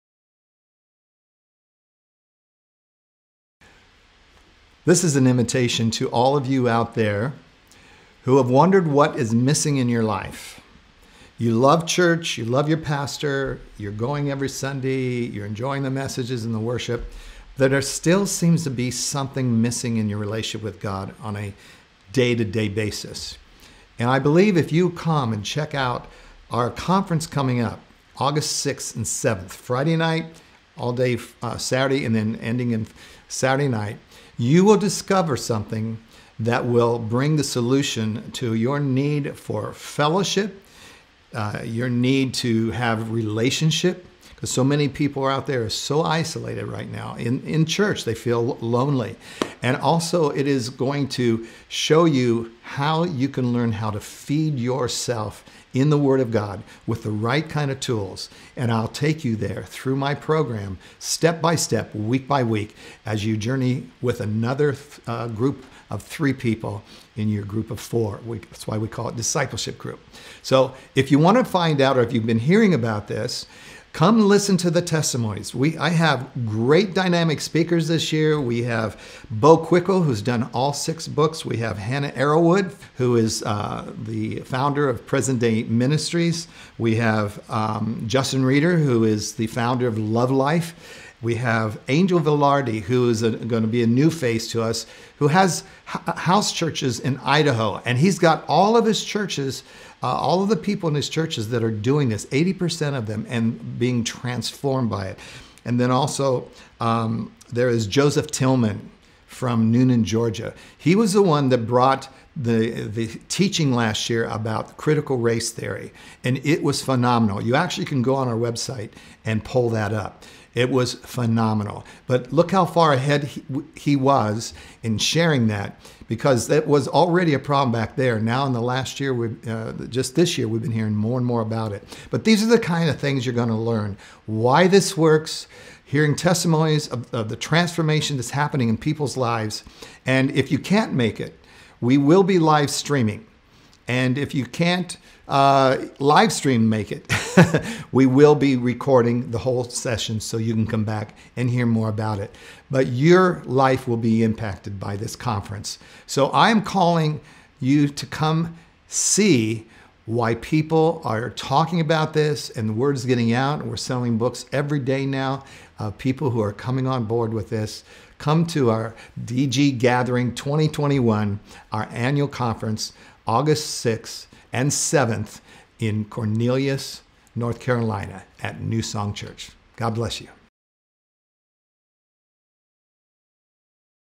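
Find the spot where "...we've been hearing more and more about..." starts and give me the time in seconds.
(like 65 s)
130 s.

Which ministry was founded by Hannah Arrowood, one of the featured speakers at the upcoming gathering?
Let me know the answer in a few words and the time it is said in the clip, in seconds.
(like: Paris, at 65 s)
Present Day Ministries, at 85 s.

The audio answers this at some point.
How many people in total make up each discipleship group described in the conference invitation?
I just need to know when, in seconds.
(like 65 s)
67 s.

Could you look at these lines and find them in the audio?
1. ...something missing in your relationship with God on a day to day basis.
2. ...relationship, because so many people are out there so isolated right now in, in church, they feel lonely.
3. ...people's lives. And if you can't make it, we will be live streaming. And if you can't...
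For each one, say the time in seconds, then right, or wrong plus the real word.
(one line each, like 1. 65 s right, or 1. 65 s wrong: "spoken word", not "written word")
1. 18 s right
2. 43 s right
3. 138 s right.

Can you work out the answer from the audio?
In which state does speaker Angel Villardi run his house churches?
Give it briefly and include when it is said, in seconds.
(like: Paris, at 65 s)
Idaho, at 97 s.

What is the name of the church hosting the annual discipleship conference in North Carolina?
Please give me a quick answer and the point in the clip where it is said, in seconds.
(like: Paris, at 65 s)
New Song Church, at 178 s.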